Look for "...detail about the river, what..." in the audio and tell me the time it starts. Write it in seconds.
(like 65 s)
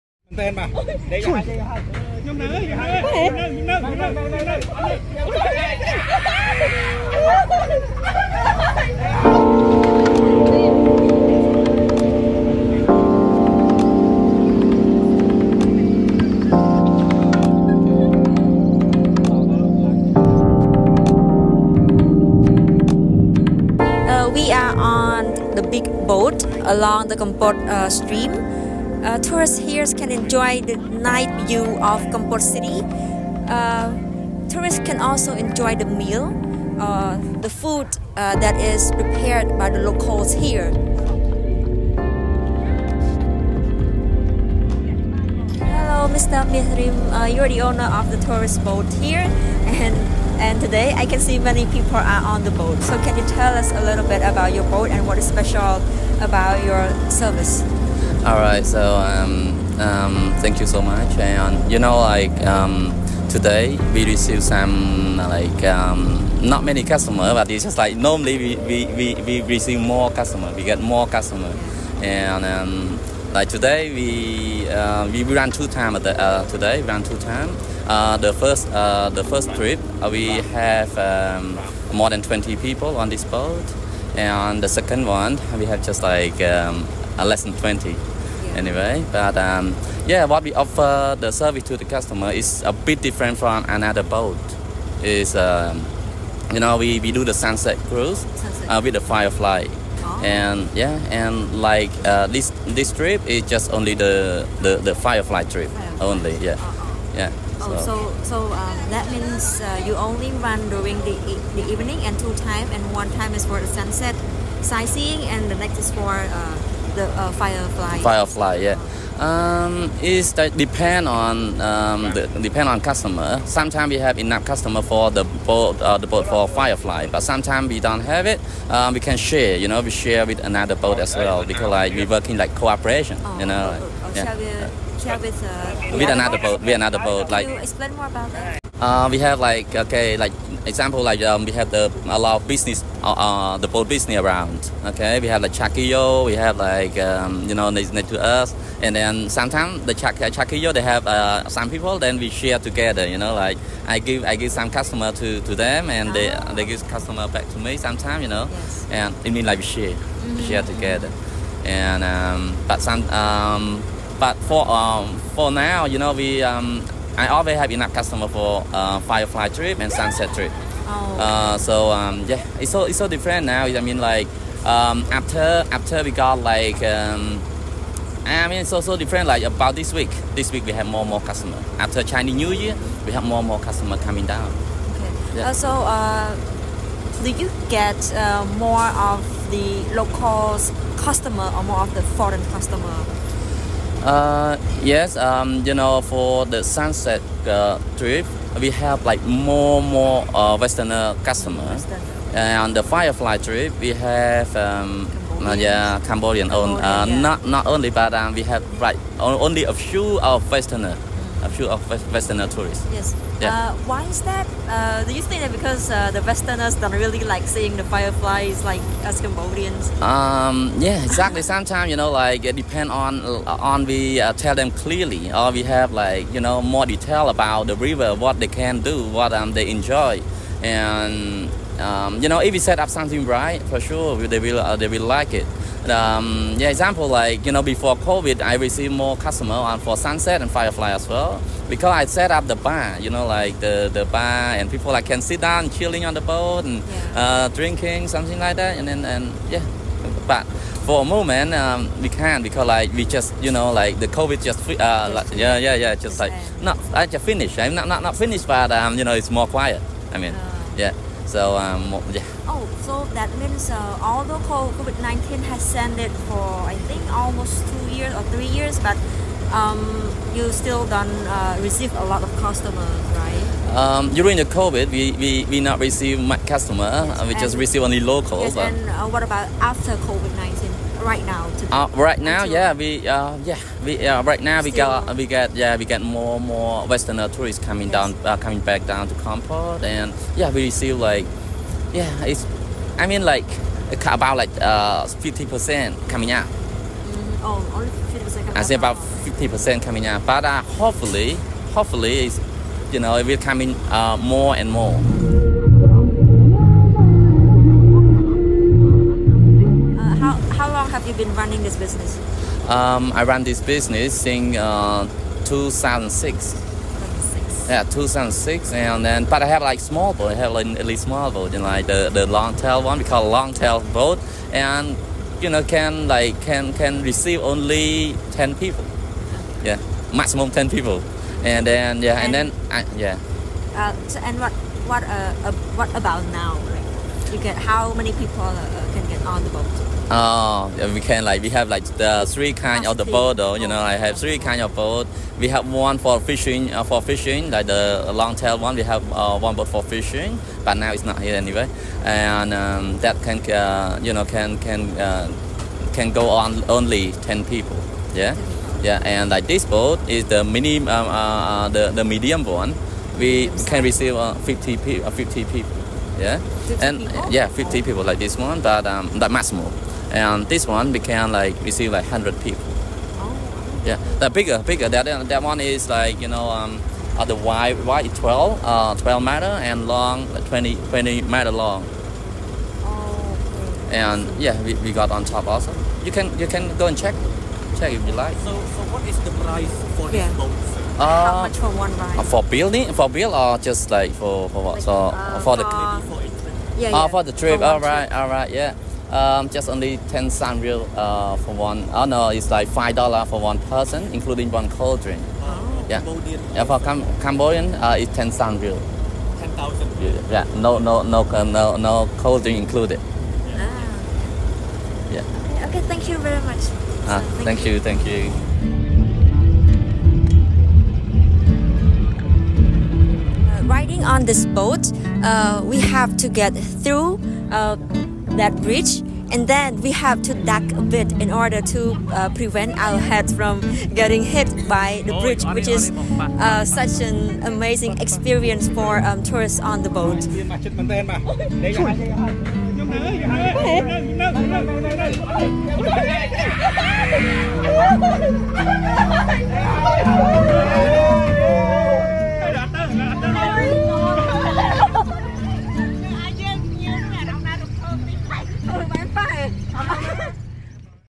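226 s.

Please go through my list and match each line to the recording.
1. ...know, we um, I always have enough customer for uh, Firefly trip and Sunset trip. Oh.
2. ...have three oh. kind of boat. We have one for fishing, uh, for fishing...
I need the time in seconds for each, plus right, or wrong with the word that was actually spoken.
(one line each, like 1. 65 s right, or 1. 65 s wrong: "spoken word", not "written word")
1. 165 s right
2. 343 s right.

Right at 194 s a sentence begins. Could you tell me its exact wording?
Uh, yes, um, you know, for the sunset uh, trip, we have like more more uh, Westerner customers.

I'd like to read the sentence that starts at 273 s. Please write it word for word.
Um, during the COVID, we, we, we not receive much customer.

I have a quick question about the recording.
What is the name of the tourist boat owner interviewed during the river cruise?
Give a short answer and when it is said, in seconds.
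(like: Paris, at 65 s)
Meas Rim, at 46 s.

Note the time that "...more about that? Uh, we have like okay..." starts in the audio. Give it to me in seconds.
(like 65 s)
137 s.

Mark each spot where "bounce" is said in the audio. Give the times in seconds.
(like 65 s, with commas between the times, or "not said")
not said.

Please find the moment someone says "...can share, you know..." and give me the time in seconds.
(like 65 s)
128 s.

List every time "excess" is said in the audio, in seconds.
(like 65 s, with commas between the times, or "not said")
not said.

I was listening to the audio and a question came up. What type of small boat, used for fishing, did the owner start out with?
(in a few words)
long tail boat.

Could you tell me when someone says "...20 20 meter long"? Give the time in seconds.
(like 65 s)
380 s.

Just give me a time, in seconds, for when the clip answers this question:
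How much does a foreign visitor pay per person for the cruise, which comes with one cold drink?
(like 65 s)
402 s.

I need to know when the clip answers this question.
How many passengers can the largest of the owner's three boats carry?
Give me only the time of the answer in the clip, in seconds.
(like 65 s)
372 s.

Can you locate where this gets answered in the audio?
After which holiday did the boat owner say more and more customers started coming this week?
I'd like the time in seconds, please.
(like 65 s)
182 s.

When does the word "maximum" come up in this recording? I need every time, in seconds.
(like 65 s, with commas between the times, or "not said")
330 s, 369 s.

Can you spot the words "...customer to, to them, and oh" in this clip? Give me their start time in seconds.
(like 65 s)
154 s.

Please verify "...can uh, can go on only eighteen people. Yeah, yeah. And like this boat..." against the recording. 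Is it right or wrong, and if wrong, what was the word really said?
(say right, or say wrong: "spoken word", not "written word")
wrong: "ten", not "eighteen".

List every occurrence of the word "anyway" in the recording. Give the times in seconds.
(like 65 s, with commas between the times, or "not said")
88 s, 351 s.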